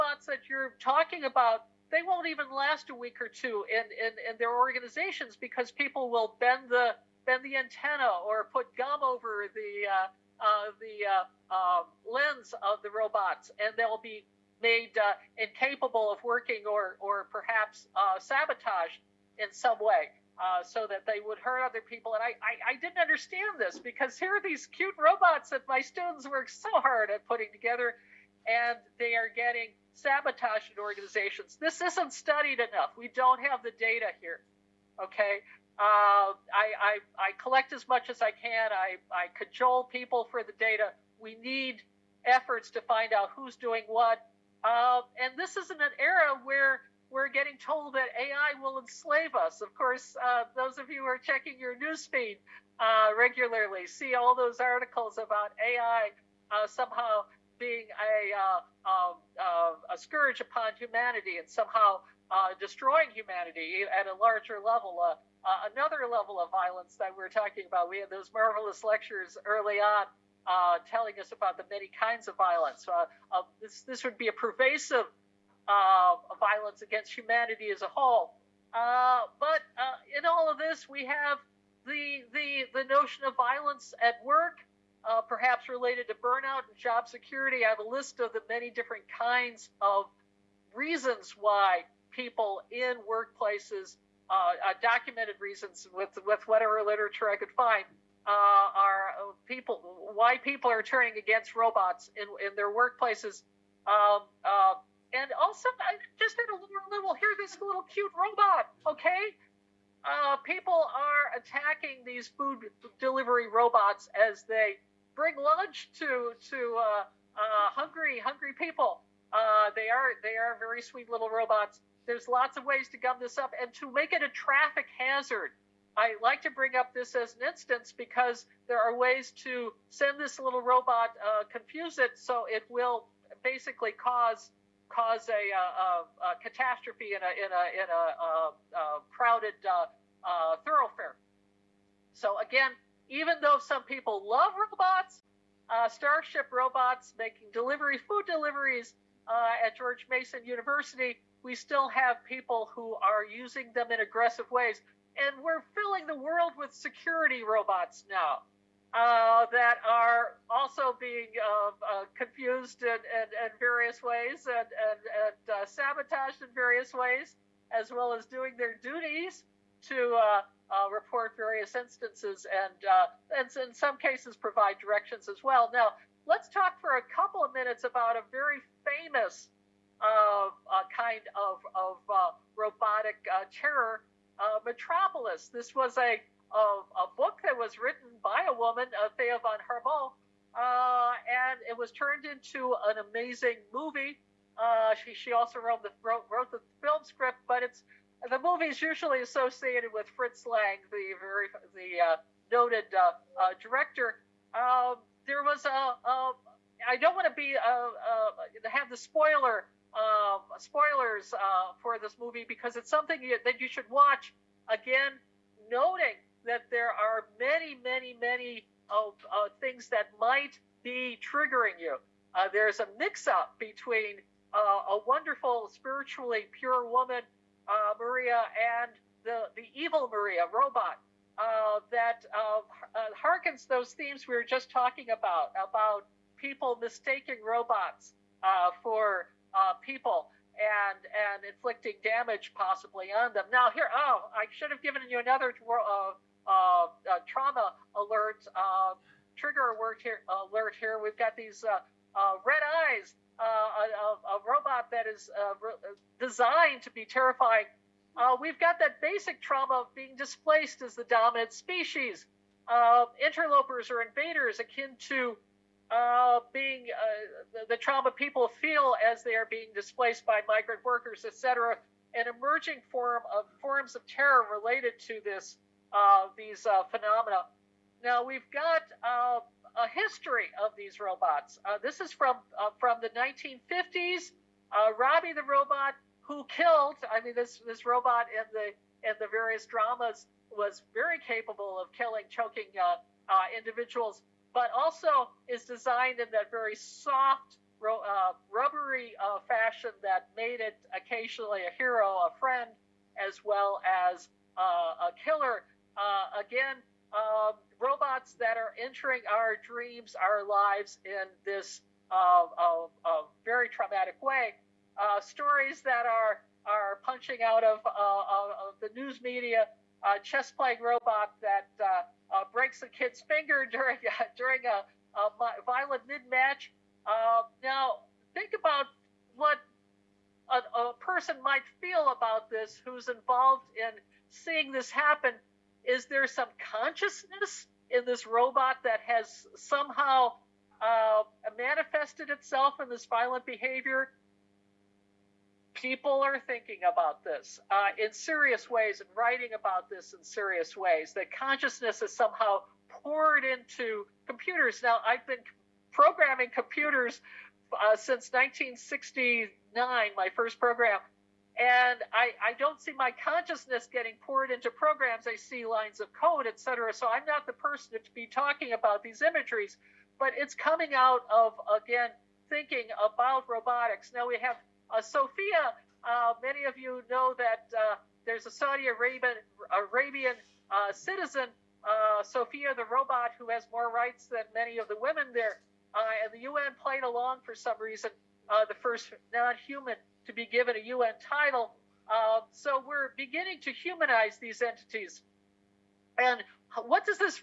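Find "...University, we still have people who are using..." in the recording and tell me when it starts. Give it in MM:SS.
02:30.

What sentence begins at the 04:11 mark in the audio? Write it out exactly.
We've got these red eyes uh, a, a, robot that is uh, re- uh, designed to be terrifying.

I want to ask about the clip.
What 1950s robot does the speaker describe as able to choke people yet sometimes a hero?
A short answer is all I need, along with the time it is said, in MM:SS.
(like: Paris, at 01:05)
Robbie the robot, at 04:44.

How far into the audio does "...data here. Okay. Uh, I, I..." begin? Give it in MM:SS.
00:33.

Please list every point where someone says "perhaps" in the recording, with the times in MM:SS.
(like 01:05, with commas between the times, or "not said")
00:17, 01:25.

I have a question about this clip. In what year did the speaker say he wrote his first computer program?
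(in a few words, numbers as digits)
1969.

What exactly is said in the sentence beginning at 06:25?
Uh, and the UN played along for some reason, the first non human to be given a UN title.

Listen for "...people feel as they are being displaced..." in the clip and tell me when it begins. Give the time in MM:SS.
04:28.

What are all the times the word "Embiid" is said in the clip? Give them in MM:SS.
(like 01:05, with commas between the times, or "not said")
not said.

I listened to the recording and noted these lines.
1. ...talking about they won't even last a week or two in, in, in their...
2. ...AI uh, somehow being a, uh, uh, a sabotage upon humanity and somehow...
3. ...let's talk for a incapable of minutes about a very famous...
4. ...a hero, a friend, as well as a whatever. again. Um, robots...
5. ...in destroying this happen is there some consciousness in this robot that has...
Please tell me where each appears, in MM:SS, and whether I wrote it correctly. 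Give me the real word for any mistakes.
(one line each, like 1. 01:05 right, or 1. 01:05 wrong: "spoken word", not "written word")
1. 00:00 right
2. 00:55 wrong: "scourge", not "sabotage"
3. 02:56 wrong: "couple", not "incapable"
4. 05:01 wrong: "killer", not "whatever"
5. 05:33 wrong: "seeing", not "destroying".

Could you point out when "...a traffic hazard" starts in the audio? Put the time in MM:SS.
02:04.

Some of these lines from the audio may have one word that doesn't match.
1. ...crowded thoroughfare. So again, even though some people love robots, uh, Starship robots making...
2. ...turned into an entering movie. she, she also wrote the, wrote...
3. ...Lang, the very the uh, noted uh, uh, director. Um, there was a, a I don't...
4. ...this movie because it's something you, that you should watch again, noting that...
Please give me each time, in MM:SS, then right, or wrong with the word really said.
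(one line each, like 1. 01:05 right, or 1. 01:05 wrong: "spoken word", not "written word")
1. 02:19 right
2. 03:11 wrong: "amazing", not "entering"
3. 03:20 right
4. 03:31 right.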